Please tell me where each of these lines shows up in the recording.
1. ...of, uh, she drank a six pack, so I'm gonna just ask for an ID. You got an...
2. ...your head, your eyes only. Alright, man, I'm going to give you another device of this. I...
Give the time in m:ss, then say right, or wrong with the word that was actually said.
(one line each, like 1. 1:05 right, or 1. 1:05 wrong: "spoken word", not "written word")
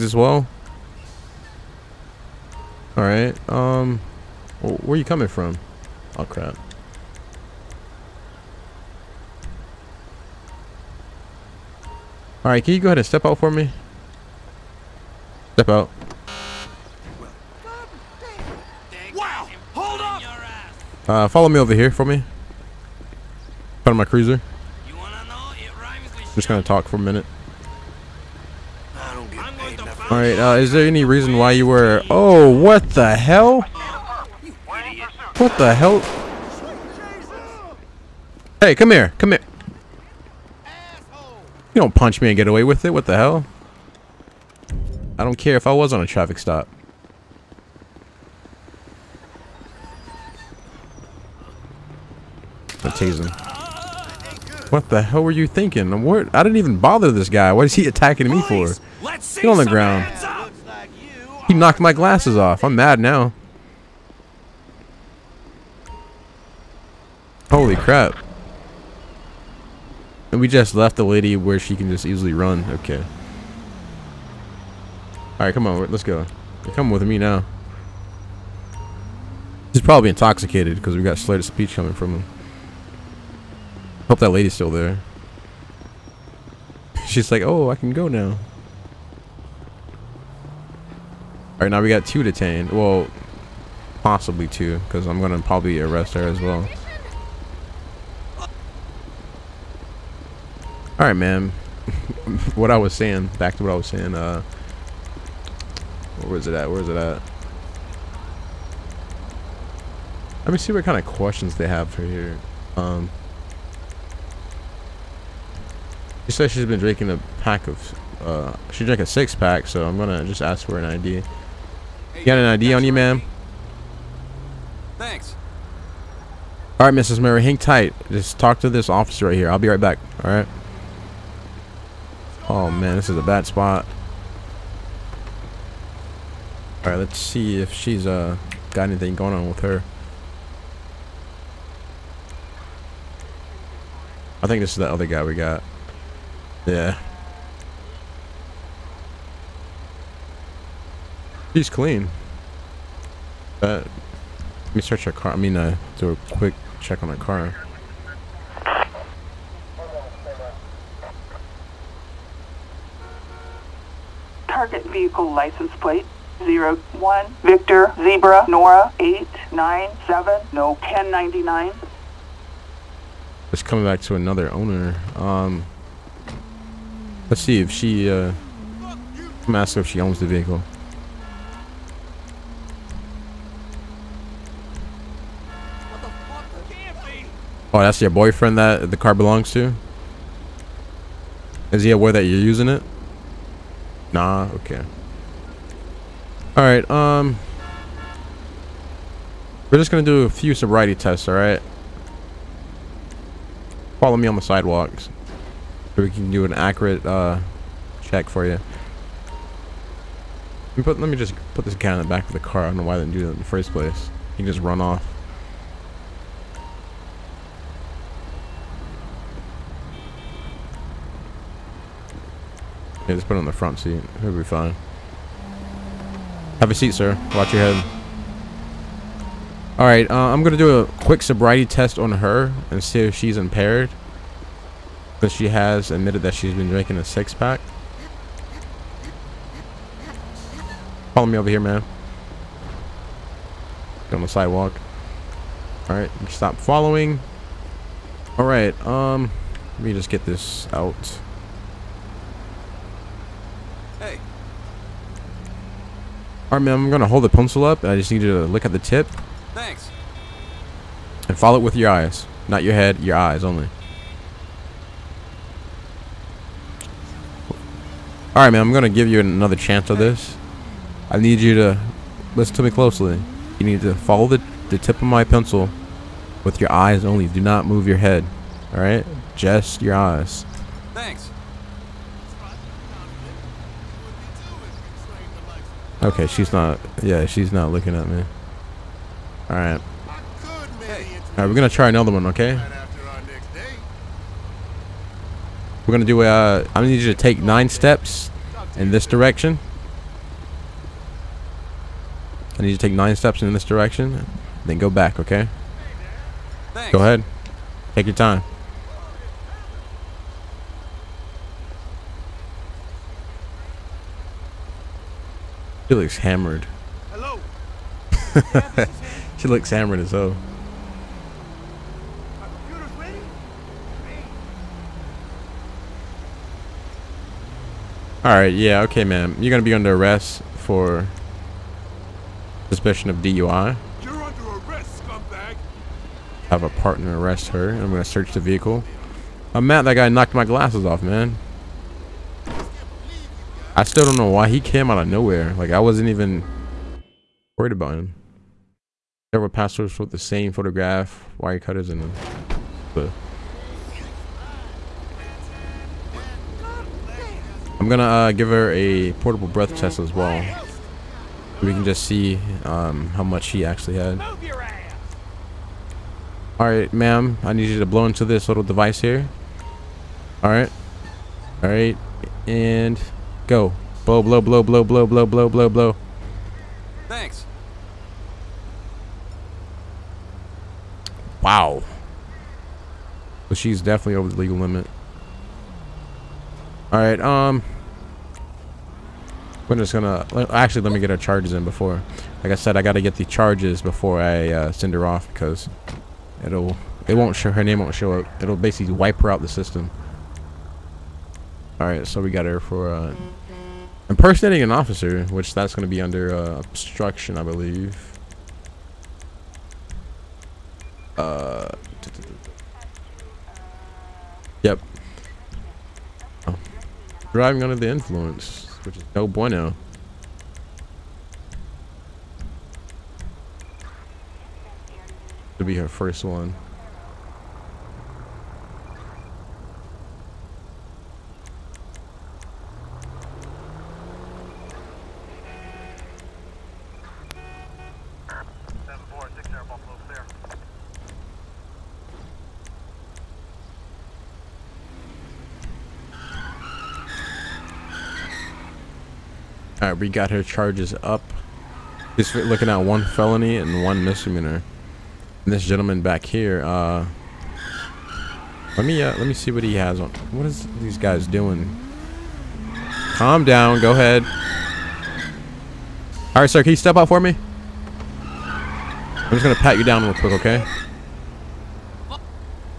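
1. 1:57 right
2. 4:22 wrong: "chance", not "device".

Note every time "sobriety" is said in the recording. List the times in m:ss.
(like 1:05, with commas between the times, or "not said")
3:20, 3:51.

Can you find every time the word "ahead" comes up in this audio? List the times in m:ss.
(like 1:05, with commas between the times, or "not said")
0:12, 5:07, 7:43.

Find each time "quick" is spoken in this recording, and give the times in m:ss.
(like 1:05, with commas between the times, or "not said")
2:36, 3:51, 7:50.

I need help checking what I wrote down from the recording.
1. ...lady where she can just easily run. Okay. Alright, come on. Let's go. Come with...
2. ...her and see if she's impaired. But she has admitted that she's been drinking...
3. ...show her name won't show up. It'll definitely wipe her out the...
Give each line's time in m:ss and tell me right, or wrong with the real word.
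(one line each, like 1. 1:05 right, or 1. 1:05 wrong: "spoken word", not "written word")
1. 1:11 right
2. 3:52 right
3. 6:37 wrong: "basically", not "definitely".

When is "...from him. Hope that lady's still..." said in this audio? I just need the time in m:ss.
1:21.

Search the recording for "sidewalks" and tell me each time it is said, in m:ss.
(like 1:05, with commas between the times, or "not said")
3:24, 4:04.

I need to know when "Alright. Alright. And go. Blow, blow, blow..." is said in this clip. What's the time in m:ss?
6:10.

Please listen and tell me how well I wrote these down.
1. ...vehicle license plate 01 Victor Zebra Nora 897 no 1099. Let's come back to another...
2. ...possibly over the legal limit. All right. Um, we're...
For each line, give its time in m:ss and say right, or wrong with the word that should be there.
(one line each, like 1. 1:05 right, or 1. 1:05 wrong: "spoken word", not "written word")
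1. 2:44 right
2. 6:23 wrong: "definitely", not "possibly".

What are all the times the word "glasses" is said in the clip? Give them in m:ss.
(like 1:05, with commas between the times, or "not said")
1:01, 5:40.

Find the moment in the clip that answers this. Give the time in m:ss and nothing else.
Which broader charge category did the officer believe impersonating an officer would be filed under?
6:46.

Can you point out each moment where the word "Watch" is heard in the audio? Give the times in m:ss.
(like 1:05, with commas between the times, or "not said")
3:47.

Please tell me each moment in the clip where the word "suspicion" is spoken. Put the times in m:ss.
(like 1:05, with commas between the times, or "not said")
5:32.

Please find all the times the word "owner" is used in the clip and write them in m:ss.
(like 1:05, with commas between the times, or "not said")
2:54.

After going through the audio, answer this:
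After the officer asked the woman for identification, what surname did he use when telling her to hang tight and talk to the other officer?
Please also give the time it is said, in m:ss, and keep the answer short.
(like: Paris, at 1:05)
Murray, at 2:06.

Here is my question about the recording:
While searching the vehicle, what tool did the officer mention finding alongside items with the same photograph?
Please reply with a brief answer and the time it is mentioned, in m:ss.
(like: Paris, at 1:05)
Wire cutters, at 5:51.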